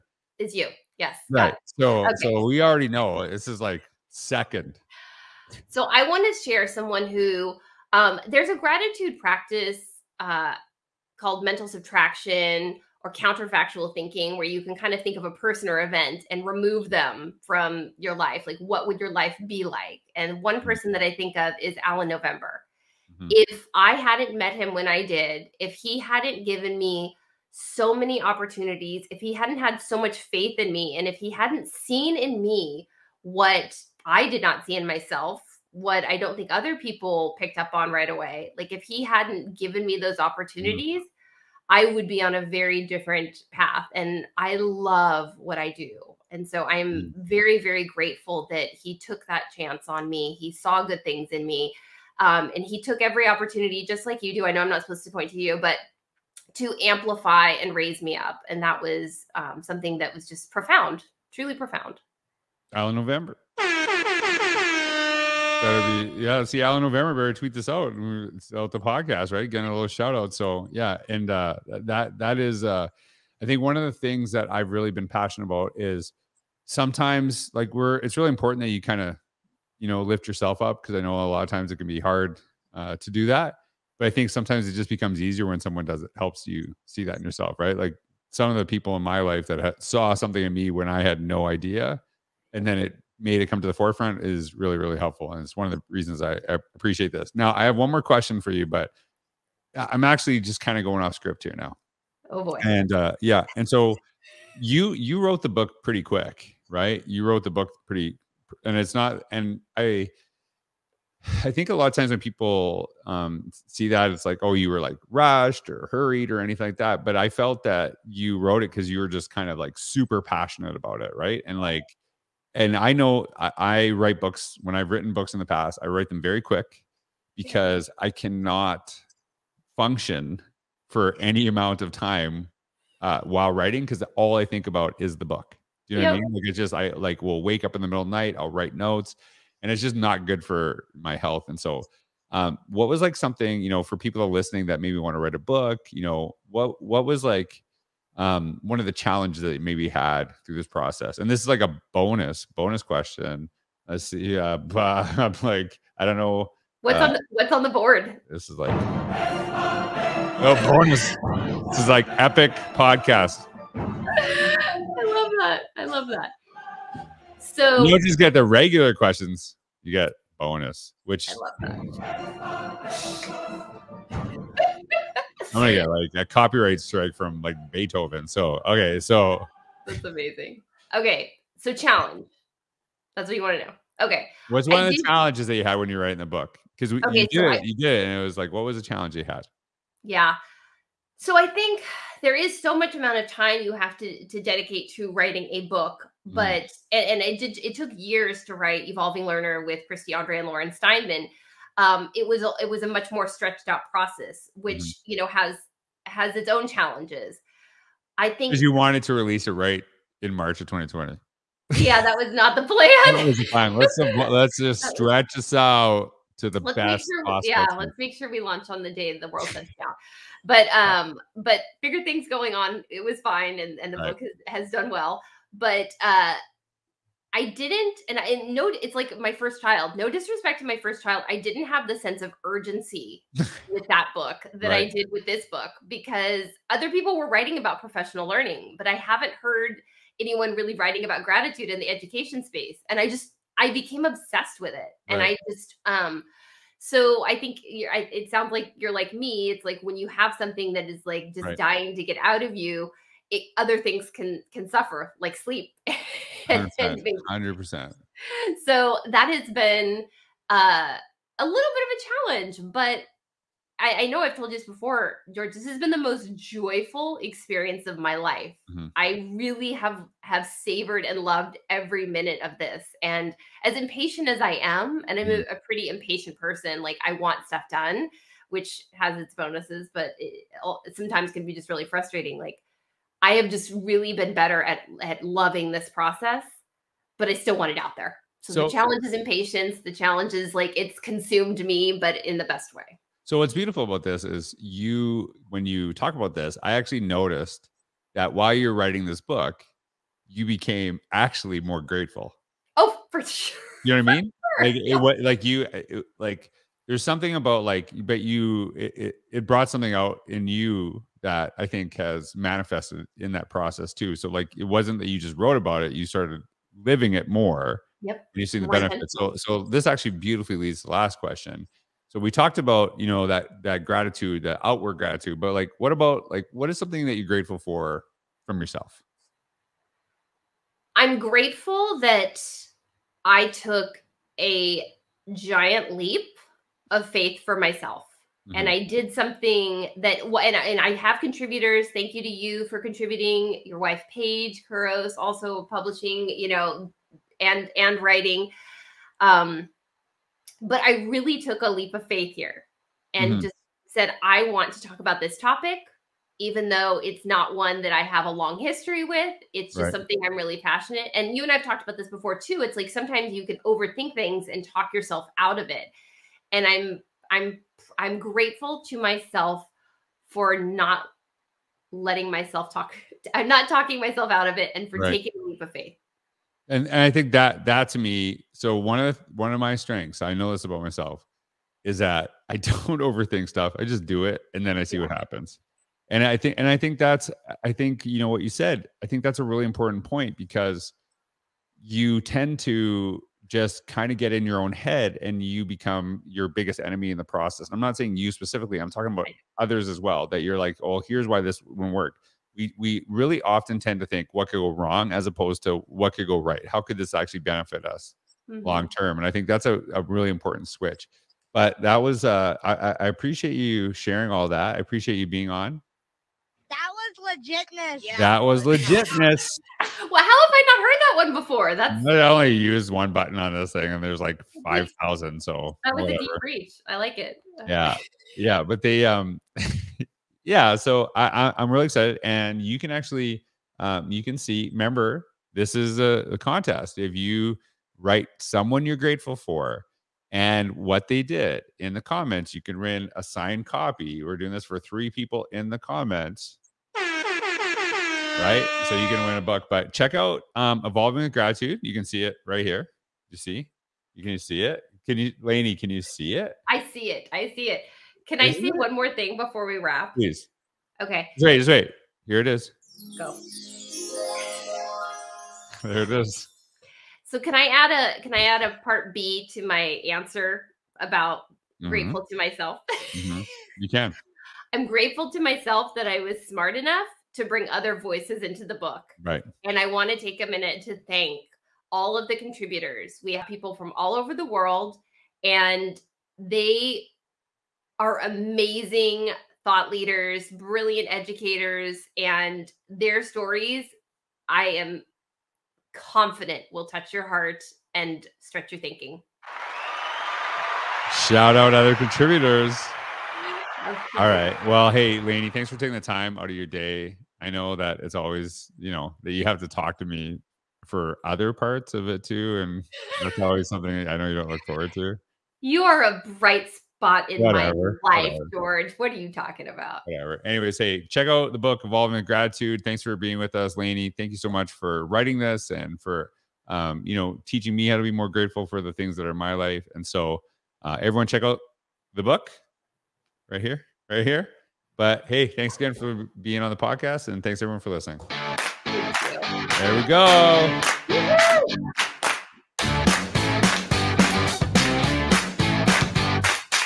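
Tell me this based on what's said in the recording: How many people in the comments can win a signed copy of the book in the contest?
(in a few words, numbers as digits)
3.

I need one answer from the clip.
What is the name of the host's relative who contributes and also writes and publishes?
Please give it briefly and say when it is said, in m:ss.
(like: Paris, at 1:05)
Paige Couros, at 5:44.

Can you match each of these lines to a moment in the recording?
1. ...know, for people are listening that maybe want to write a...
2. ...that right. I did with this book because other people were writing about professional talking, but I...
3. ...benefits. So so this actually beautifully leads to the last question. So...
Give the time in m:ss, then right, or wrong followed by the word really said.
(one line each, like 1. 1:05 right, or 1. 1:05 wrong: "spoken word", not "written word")
1. 2:23 right
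2. 3:54 wrong: "learning", not "talking"
3. 5:18 right.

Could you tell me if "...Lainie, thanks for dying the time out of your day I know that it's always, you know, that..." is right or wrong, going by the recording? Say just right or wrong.
wrong.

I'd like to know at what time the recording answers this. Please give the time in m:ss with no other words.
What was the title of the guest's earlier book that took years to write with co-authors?
3:18.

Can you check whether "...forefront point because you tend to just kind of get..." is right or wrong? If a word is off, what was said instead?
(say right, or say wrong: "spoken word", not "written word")
wrong: "important", not "forefront".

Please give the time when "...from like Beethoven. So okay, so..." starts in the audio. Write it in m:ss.
2:57.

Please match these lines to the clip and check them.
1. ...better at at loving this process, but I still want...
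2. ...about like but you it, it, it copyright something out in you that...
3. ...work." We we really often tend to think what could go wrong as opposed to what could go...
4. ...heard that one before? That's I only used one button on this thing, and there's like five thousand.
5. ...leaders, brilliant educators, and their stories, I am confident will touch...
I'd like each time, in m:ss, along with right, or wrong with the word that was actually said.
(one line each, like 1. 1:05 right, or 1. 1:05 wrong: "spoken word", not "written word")
1. 4:44 right
2. 5:07 wrong: "brought", not "copyright"
3. 6:41 right
4. 7:00 right
5. 8:09 right.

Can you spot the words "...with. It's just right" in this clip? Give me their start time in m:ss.
5:59.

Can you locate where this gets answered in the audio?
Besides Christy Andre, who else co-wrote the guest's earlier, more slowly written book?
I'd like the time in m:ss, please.
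3:20.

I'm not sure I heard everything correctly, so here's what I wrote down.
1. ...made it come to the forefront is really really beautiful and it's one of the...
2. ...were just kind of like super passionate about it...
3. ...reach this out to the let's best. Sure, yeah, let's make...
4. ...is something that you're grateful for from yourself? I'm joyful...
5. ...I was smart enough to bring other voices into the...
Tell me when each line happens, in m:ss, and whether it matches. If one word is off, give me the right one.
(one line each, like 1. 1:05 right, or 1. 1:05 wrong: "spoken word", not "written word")
1. 1:33 wrong: "helpful", not "beautiful"
2. 1:58 right
3. 3:34 wrong: "stretch", not "reach"
4. 5:26 wrong: "grateful", not "joyful"
5. 7:56 right.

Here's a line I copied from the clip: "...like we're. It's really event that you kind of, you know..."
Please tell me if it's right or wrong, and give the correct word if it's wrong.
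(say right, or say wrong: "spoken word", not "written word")
wrong: "important", not "event".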